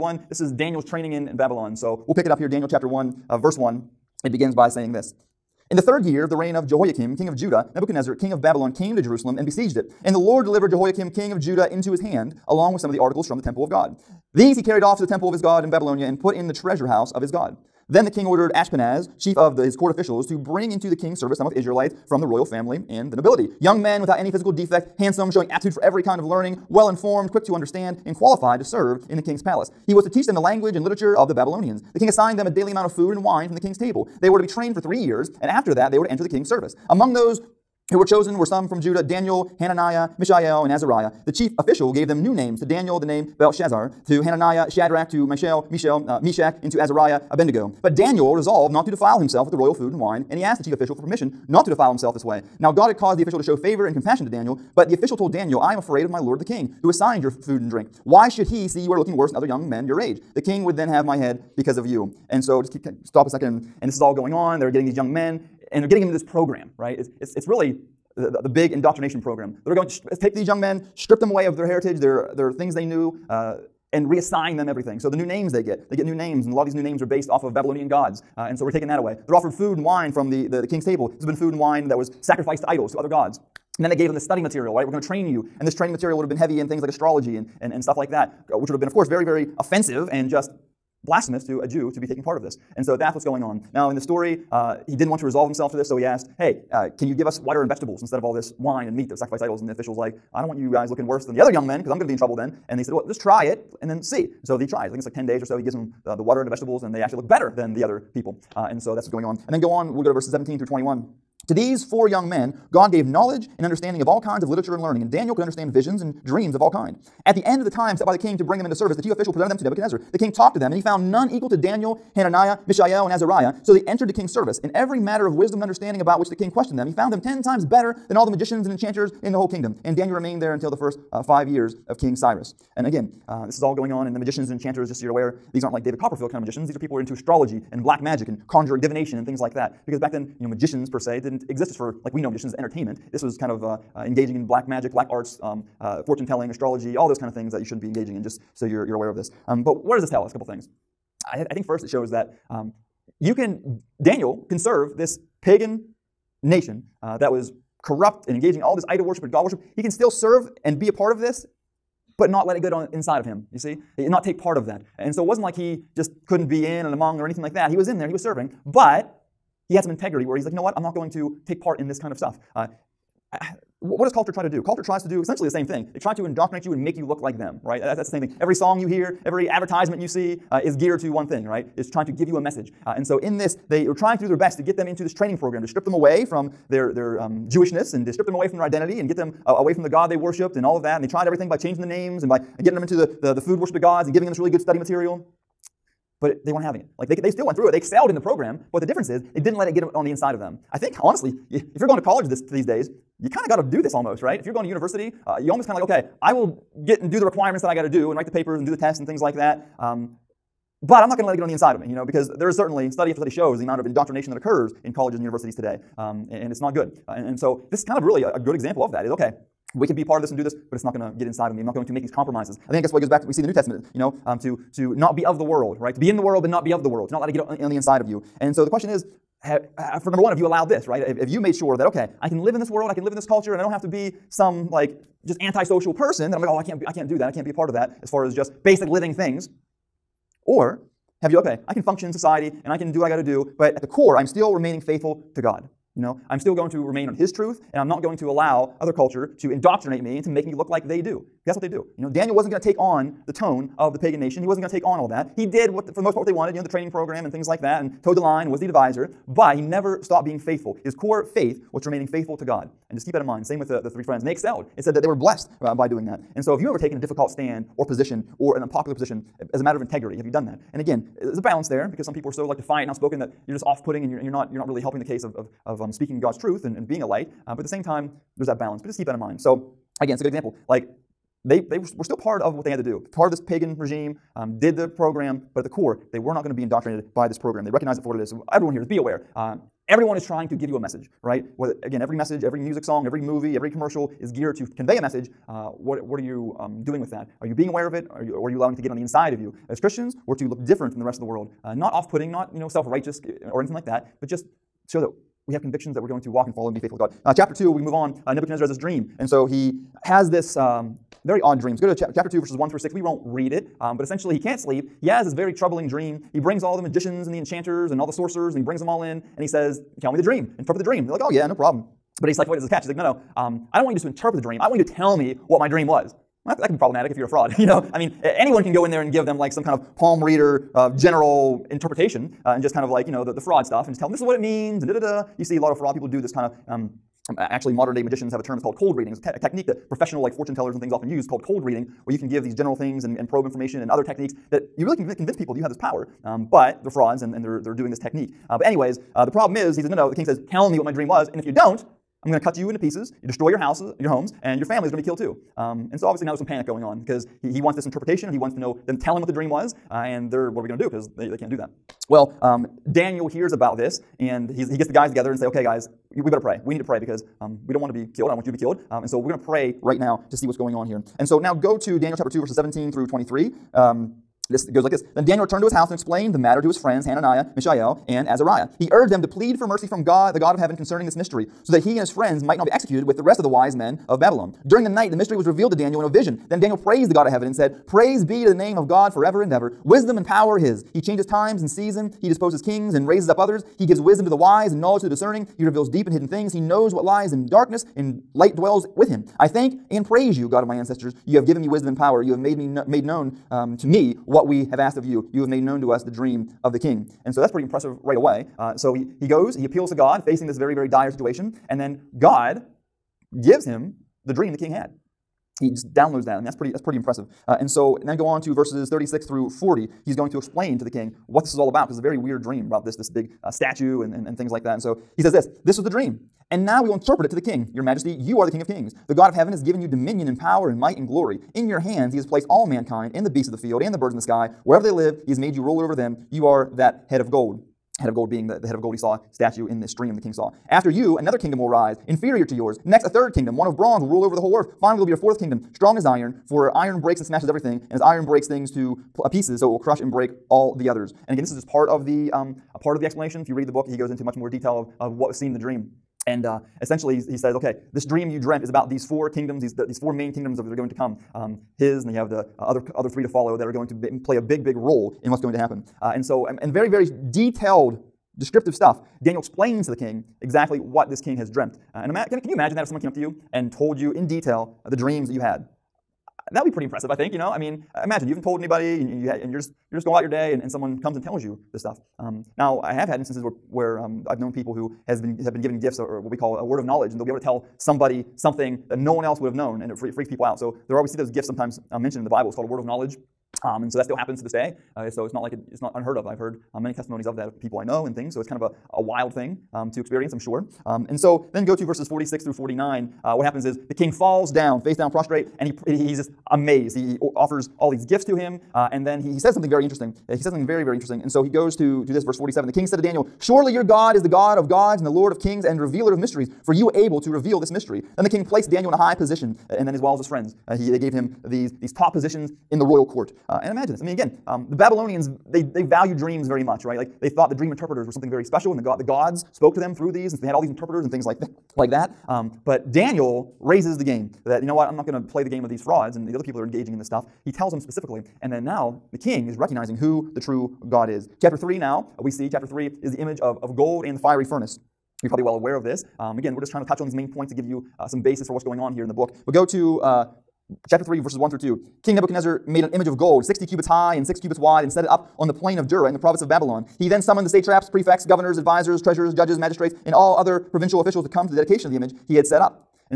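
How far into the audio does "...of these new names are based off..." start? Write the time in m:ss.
1:16.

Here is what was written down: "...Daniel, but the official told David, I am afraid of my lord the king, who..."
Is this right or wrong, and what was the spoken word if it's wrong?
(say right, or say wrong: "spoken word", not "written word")
wrong: "Daniel", not "David".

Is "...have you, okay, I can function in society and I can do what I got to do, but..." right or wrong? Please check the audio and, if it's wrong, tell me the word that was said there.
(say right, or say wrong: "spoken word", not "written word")
right.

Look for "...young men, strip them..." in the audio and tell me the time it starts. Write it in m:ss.
1:10.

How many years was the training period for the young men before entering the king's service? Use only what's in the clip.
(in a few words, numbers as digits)
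3.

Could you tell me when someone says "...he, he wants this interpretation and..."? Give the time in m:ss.
5:57.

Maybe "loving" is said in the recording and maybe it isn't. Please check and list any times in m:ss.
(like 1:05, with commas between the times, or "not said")
not said.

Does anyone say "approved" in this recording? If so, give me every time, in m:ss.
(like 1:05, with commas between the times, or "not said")
not said.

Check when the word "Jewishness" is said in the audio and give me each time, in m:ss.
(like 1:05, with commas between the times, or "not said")
3:07.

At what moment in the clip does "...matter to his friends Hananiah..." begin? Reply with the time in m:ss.
6:16.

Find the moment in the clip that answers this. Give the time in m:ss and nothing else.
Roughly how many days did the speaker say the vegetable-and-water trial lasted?
1:45.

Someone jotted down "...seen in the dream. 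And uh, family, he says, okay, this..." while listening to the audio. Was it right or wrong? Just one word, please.
wrong.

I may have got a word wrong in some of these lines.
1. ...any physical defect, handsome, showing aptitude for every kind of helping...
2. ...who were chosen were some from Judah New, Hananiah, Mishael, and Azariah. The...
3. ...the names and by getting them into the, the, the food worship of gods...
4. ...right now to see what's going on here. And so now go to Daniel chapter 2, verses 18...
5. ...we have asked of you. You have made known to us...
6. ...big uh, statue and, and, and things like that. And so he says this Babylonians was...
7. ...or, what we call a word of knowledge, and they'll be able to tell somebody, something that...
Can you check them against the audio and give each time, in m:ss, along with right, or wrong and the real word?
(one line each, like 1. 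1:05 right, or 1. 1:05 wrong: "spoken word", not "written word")
1. 0:24 wrong: "learning", not "helping"
2. 0:37 wrong: "Daniel", not "New"
3. 3:11 right
4. 6:09 wrong: "17", not "18"
5. 6:44 right
6. 7:03 wrong: "This", not "Babylonians"
7. 8:06 right.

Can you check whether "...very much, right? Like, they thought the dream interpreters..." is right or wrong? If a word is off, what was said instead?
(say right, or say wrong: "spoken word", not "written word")
right.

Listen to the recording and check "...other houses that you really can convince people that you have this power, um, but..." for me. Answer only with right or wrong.
wrong.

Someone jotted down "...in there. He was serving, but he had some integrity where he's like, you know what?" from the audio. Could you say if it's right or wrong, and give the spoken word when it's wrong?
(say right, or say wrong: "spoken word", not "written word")
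right.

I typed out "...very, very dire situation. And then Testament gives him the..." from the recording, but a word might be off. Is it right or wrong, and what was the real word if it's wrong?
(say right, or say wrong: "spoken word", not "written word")
wrong: "God", not "Testament".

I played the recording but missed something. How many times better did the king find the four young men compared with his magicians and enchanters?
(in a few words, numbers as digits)
10.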